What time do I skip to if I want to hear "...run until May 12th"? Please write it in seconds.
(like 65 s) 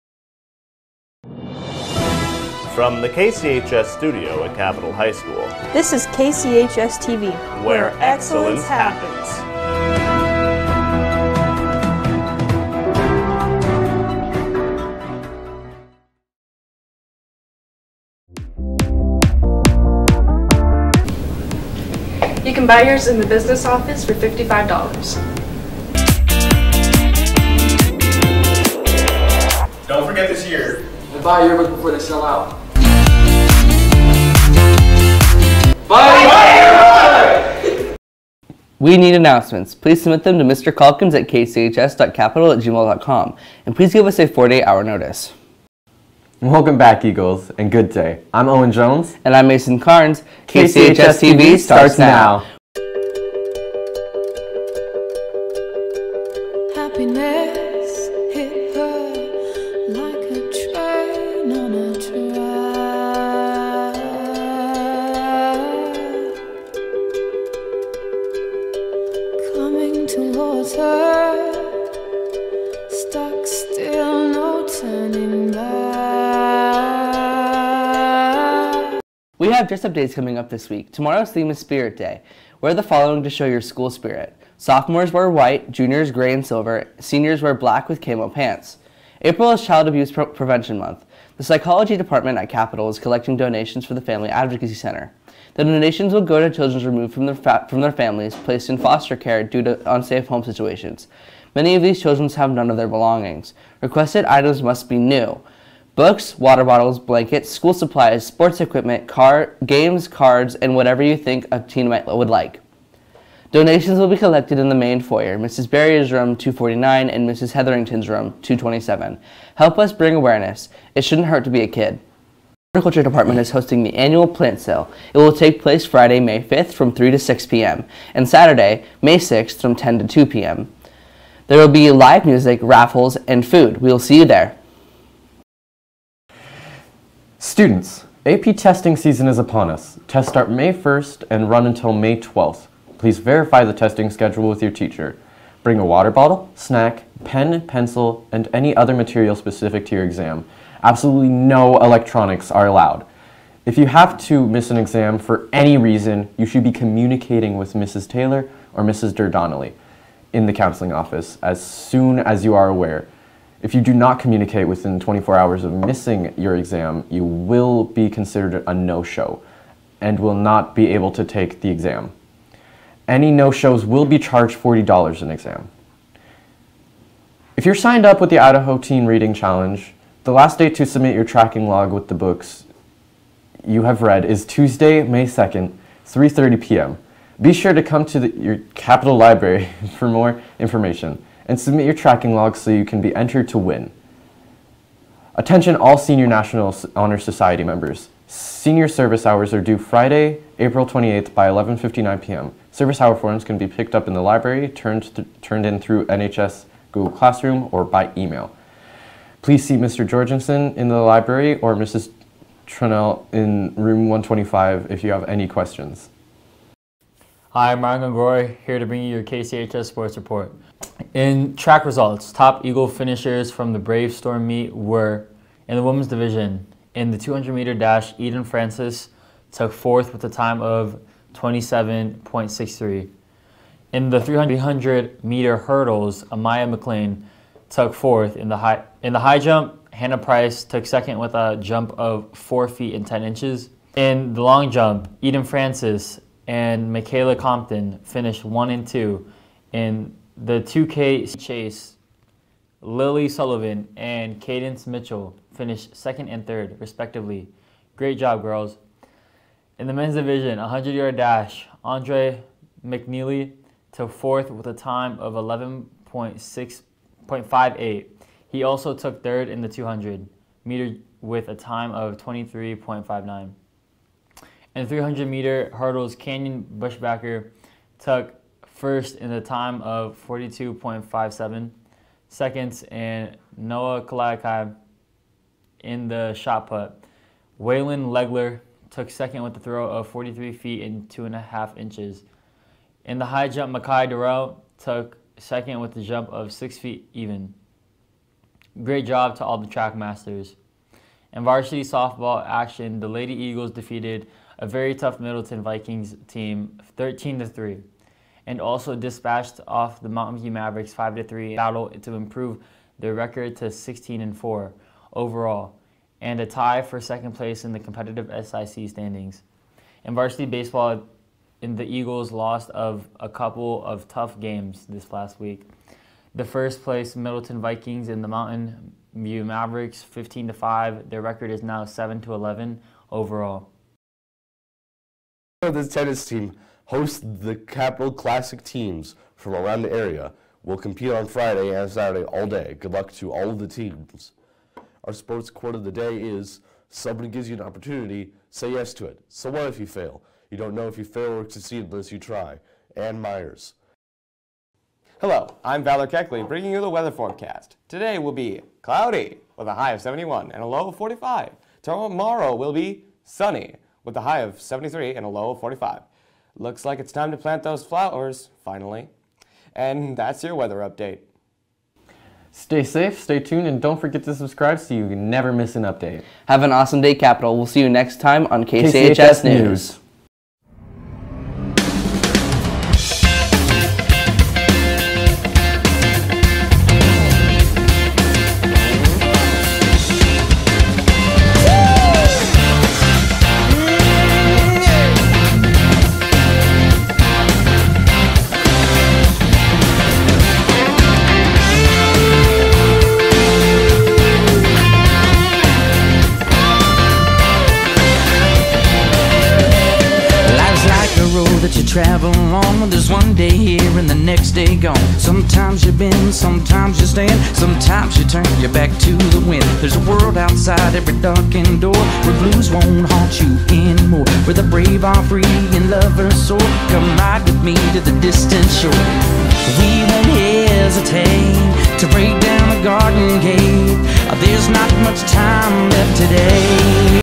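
141 s.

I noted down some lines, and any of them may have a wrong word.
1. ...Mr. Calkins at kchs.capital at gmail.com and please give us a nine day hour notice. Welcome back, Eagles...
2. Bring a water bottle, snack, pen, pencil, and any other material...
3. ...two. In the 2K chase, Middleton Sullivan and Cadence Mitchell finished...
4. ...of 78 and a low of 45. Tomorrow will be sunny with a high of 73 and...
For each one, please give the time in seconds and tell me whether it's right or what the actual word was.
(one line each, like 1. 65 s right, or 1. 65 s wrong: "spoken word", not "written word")
1. 40 s wrong: "four", not "nine"
2. 145 s right
3. 248 s wrong: "Lily", not "Middleton"
4. 359 s wrong: "71", not "78".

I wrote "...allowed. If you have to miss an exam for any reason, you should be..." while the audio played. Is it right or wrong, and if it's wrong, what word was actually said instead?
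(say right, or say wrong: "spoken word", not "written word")
right.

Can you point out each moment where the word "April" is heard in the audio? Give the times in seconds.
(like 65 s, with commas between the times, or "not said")
89 s, 200 s.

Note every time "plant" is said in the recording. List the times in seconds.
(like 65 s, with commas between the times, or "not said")
124 s, 367 s.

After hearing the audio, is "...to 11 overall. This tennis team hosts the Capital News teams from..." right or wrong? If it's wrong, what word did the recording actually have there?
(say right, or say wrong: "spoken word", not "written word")
wrong: "Classic", not "News".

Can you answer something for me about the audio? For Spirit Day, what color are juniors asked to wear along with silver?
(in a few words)
gray.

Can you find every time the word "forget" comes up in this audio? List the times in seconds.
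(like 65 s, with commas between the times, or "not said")
30 s, 373 s.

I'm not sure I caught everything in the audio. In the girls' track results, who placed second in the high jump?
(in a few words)
Hannah Price.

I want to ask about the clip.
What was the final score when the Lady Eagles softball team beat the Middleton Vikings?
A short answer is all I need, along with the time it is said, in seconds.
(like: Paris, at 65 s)
13 to 3, at 306 s.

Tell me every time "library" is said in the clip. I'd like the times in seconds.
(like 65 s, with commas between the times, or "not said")
189 s, 204 s, 210 s.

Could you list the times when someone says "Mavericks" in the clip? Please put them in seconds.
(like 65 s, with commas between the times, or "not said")
310 s, 329 s.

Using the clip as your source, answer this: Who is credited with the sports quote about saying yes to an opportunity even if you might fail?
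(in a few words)
Ann Meyers.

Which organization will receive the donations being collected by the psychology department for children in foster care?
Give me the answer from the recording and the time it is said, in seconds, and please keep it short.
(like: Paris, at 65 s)
Family Advocacy Center, at 94 s.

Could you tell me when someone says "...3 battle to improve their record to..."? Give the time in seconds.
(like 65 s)
311 s.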